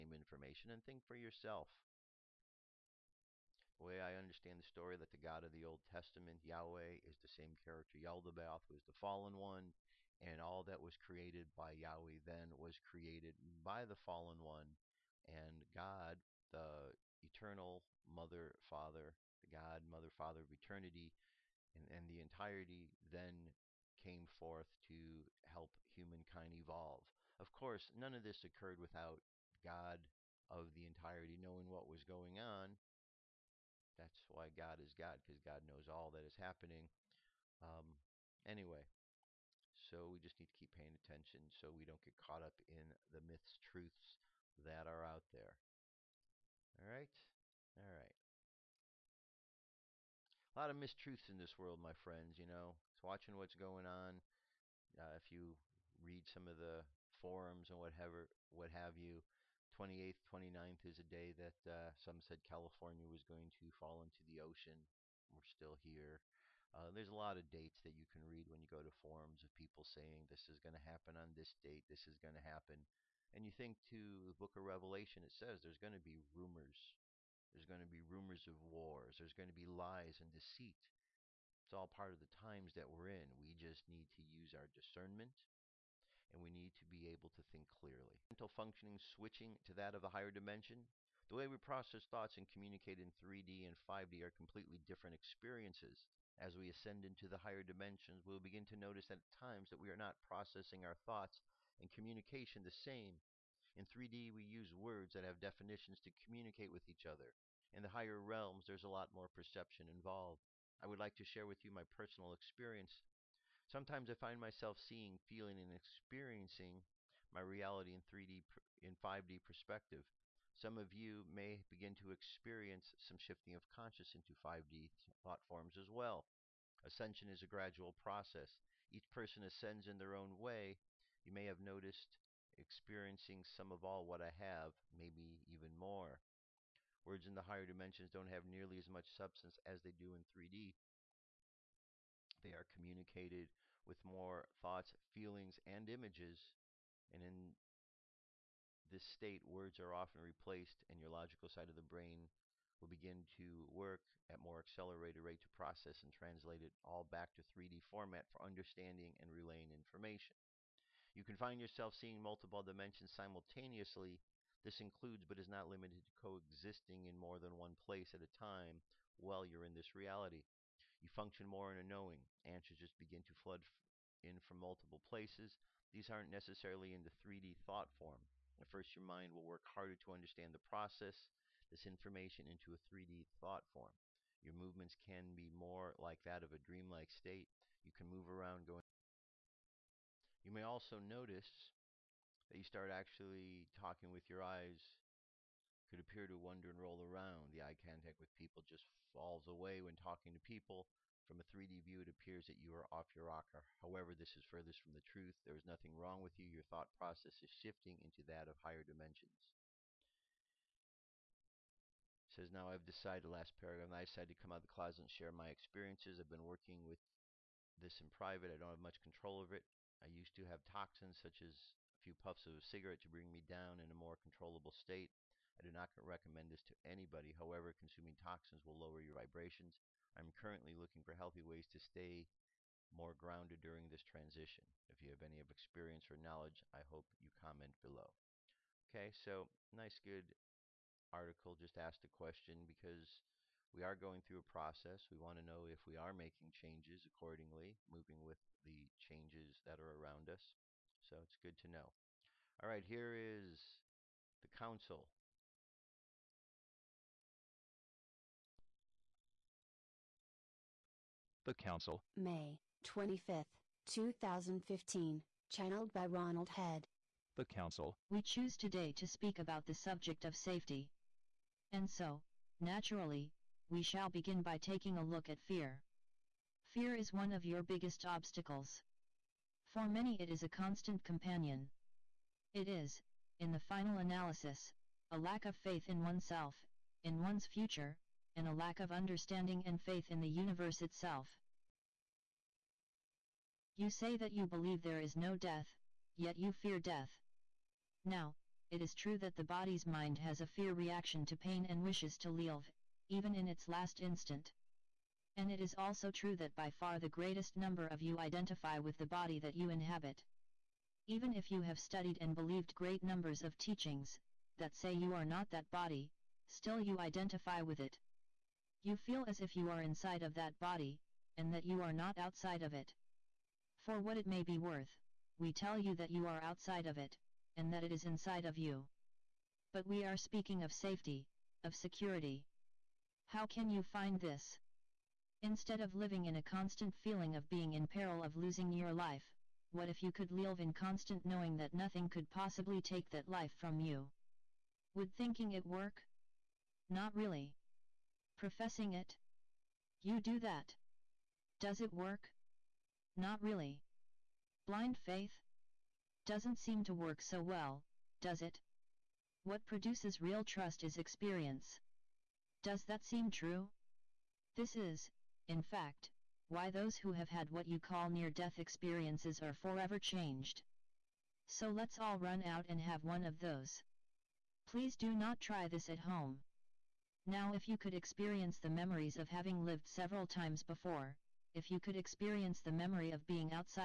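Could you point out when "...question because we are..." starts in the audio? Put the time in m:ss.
4:02.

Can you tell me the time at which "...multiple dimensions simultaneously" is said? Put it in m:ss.
2:42.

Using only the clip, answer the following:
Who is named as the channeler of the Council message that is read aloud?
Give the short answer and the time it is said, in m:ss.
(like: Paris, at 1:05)
Ronald Head, at 4:26.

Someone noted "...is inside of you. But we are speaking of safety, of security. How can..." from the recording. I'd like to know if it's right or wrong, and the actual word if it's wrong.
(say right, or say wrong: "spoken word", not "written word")
right.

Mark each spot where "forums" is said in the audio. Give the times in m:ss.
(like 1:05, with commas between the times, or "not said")
0:57, 1:08.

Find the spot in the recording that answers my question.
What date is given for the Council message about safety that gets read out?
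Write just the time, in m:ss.
4:22.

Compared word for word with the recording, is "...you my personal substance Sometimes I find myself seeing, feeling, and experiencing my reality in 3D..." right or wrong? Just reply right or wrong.
wrong.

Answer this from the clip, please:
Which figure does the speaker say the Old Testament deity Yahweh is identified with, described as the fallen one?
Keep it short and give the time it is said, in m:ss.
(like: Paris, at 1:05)
Yaldabaoth, at 0:07.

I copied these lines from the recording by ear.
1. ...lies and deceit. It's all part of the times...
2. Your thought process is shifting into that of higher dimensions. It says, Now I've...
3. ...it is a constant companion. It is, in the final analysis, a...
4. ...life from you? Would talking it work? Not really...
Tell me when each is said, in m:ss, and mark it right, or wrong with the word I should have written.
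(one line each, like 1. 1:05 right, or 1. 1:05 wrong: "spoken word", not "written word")
1. 1:19 right
2. 3:26 right
3. 4:40 right
4. 5:43 wrong: "thinking", not "talking".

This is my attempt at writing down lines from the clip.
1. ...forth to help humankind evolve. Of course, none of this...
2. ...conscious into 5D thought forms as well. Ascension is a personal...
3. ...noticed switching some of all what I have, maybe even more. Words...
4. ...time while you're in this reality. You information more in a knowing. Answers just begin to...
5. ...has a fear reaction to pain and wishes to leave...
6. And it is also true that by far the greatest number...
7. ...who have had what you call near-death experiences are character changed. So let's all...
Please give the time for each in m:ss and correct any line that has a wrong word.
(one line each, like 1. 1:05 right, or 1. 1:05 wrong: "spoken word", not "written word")
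1. 0:24 right
2. 2:03 wrong: "gradual", not "personal"
3. 2:11 wrong: "experiencing", not "switching"
4. 2:48 wrong: "function", not "information"
5. 5:00 right
6. 5:05 right
7. 6:06 wrong: "forever", not "character".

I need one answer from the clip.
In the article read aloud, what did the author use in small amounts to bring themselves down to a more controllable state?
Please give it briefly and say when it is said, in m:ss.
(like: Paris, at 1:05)
a cigarette, at 3:42.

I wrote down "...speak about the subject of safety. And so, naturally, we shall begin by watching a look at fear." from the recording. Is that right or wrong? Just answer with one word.
wrong.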